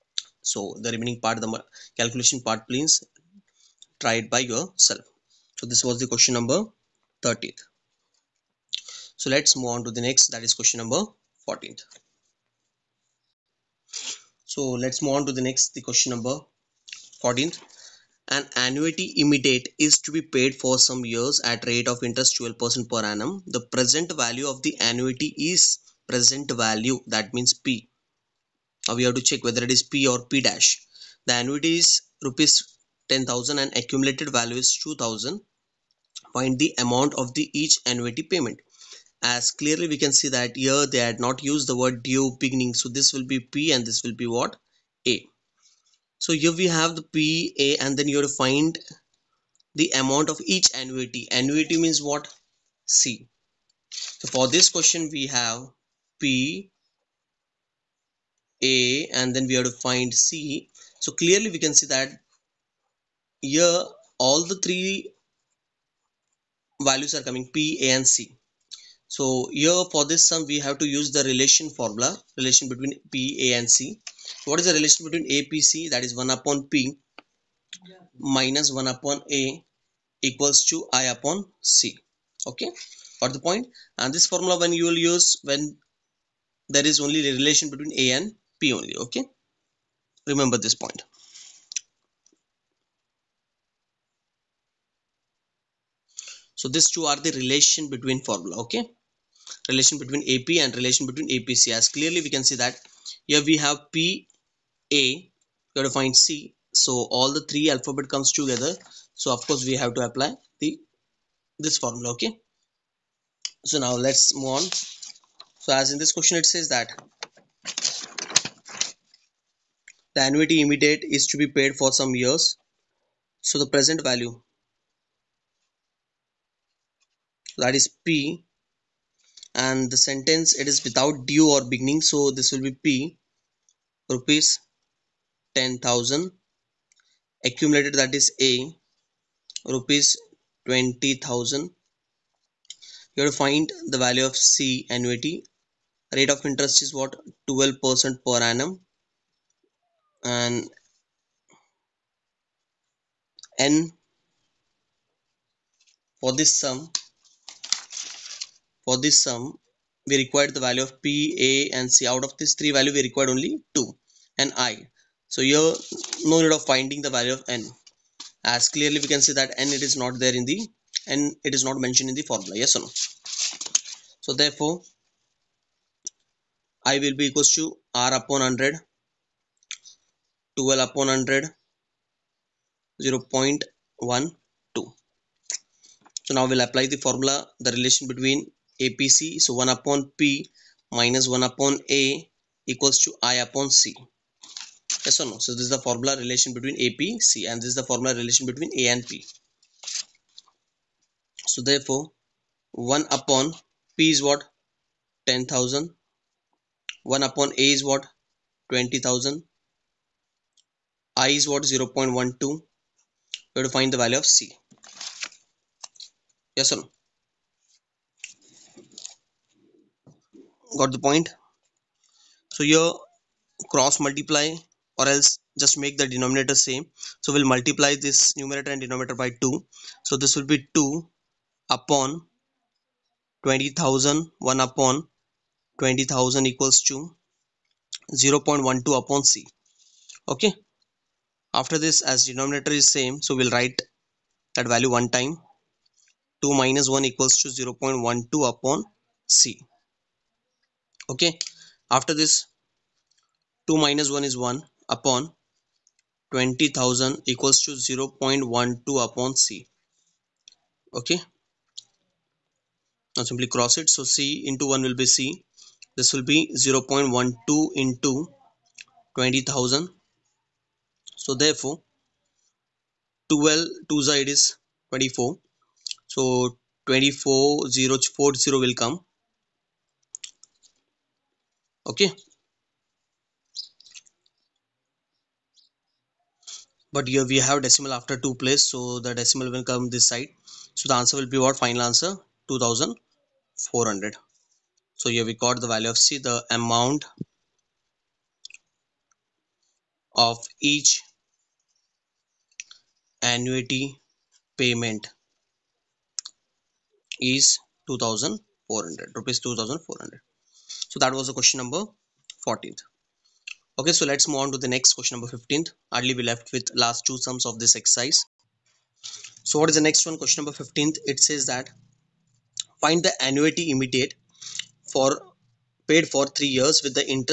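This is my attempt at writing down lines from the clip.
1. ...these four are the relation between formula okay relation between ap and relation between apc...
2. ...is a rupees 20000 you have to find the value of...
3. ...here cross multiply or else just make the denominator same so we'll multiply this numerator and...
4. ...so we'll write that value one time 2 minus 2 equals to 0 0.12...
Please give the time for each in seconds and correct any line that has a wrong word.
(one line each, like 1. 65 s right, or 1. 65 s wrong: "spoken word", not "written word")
1. 96 s wrong: "two", not "four"
2. 138 s right
3. 222 s right
4. 243 s wrong: "1", not "2".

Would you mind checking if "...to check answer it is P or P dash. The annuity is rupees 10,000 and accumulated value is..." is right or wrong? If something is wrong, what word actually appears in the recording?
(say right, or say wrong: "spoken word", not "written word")
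wrong: "whether", not "answer".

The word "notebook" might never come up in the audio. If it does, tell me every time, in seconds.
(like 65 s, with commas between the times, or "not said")
not said.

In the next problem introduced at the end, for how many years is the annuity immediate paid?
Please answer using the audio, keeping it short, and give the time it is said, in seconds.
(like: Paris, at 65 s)
3 years, at 326 s.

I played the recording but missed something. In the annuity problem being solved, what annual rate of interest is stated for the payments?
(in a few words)
12%.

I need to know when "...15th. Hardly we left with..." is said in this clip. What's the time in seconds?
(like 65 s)
315 s.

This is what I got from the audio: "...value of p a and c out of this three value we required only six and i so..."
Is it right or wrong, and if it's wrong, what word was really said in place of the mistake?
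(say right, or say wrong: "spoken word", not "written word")
wrong: "two", not "six".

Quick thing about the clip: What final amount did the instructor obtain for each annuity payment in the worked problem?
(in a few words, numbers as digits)
Rs 2400.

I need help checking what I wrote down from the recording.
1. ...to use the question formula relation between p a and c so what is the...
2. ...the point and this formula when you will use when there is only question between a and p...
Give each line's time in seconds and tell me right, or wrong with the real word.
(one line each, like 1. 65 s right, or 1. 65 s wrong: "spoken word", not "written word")
1. 70 s wrong: "relation", not "question"
2. 83 s wrong: "relation", not "question".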